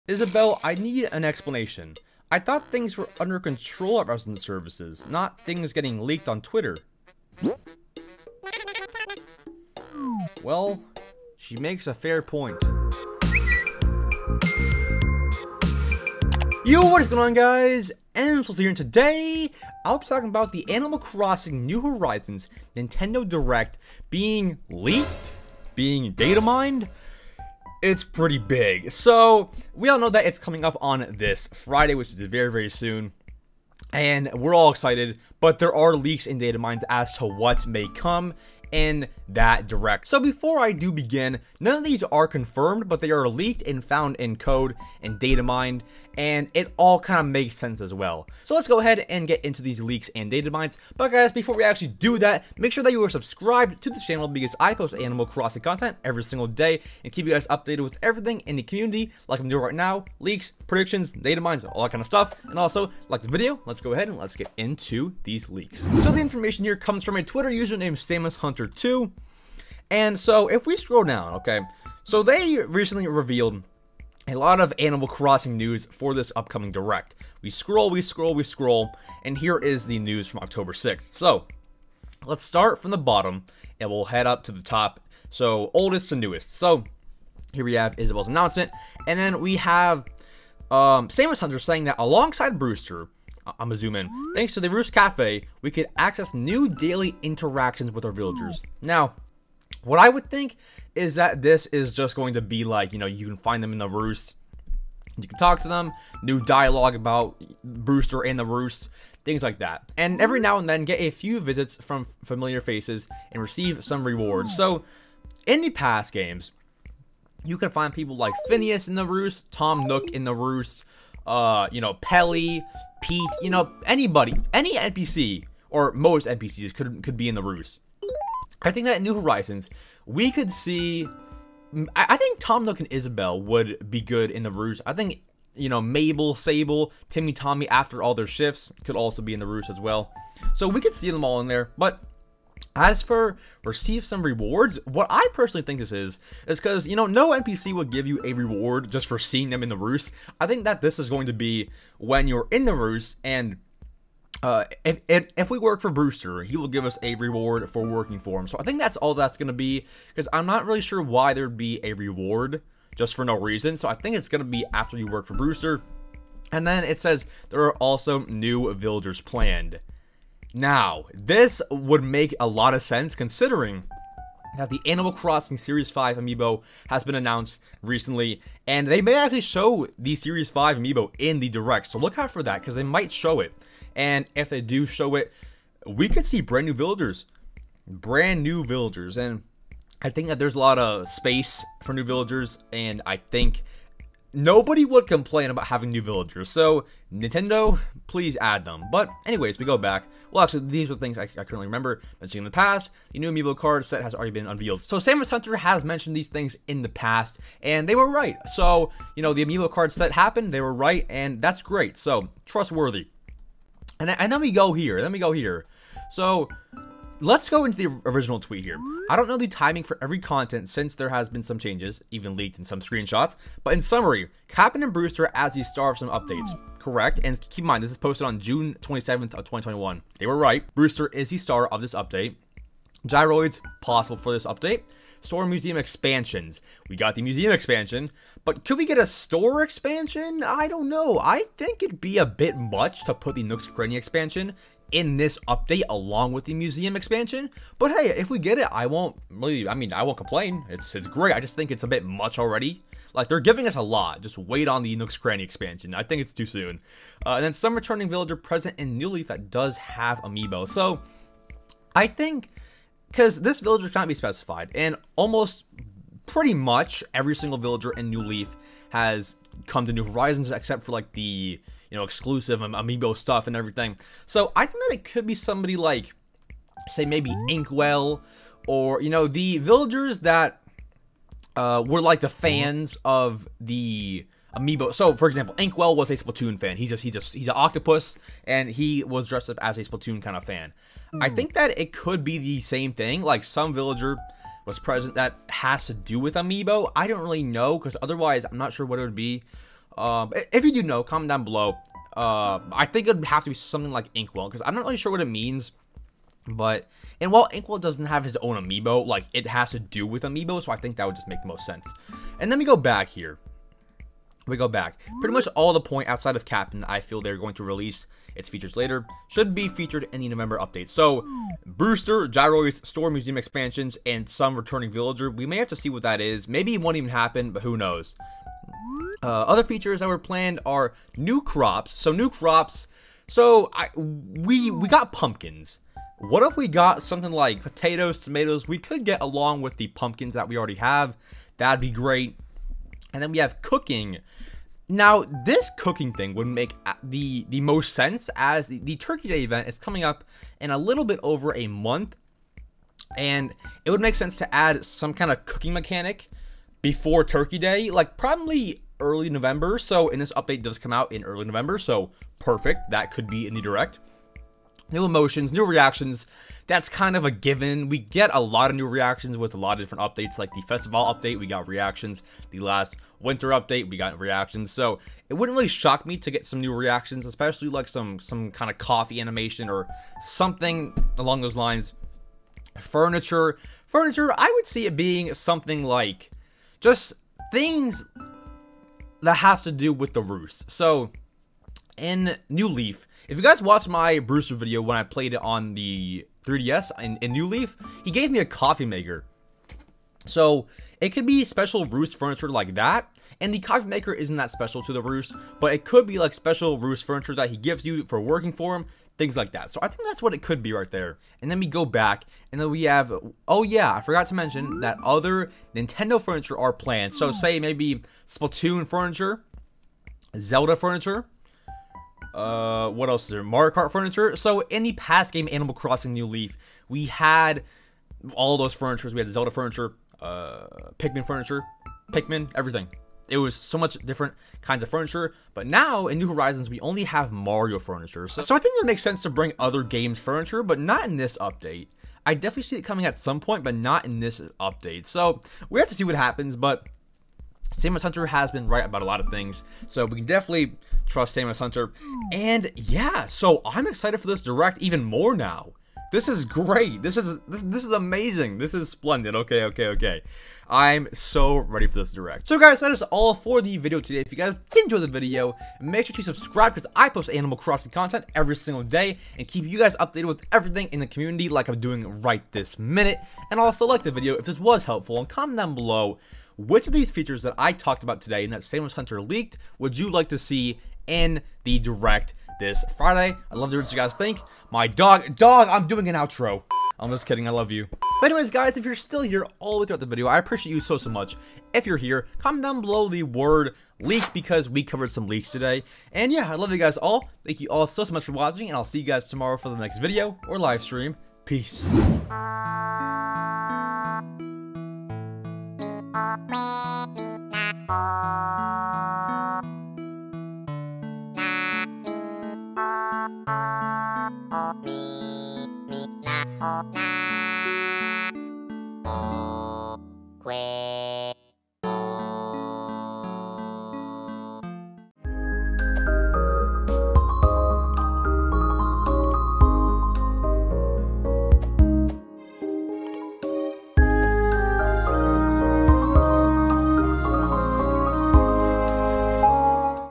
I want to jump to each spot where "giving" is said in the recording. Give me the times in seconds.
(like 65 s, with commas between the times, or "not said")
253 s.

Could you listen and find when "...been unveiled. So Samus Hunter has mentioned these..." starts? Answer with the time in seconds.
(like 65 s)
204 s.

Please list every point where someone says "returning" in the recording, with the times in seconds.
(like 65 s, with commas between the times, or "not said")
257 s, 324 s.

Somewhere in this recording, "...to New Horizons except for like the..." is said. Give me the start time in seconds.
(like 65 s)
269 s.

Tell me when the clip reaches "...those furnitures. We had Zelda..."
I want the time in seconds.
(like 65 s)
428 s.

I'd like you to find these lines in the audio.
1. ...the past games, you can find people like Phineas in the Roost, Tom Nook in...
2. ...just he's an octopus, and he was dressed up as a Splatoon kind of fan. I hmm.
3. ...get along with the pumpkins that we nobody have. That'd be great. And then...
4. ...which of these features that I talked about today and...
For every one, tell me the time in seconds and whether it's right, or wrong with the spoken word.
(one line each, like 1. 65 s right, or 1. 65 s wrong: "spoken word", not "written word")
1. 115 s right
2. 287 s right
3. 339 s wrong: "already", not "nobody"
4. 476 s right.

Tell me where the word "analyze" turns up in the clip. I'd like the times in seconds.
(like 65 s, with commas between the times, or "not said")
not said.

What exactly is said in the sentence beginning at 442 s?
I definitely see it coming at some point, but not in this update.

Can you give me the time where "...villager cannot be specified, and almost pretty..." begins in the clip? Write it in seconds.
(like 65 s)
263 s.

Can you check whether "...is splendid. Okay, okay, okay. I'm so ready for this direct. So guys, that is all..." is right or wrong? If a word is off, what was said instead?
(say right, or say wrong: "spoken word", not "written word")
right.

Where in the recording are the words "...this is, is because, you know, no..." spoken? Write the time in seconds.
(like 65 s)
145 s.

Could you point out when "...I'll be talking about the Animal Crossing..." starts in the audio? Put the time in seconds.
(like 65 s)
19 s.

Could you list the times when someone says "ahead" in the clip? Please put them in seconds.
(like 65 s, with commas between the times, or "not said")
48 s, 63 s.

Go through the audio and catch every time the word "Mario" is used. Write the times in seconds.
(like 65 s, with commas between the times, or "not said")
423 s, 437 s.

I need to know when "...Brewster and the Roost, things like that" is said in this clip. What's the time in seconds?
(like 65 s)
107 s.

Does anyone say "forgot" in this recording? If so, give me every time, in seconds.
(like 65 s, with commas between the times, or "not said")
414 s.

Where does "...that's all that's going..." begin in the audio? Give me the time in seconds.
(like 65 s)
158 s.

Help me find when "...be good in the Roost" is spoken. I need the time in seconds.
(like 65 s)
133 s.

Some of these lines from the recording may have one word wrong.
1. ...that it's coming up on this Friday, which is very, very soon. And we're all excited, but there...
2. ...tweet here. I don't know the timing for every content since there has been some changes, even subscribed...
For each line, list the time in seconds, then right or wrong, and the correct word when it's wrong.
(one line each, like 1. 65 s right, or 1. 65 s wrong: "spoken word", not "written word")
1. 30 s right
2. 218 s wrong: "leaked", not "subscribed".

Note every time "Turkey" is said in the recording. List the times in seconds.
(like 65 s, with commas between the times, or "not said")
348 s, 357 s.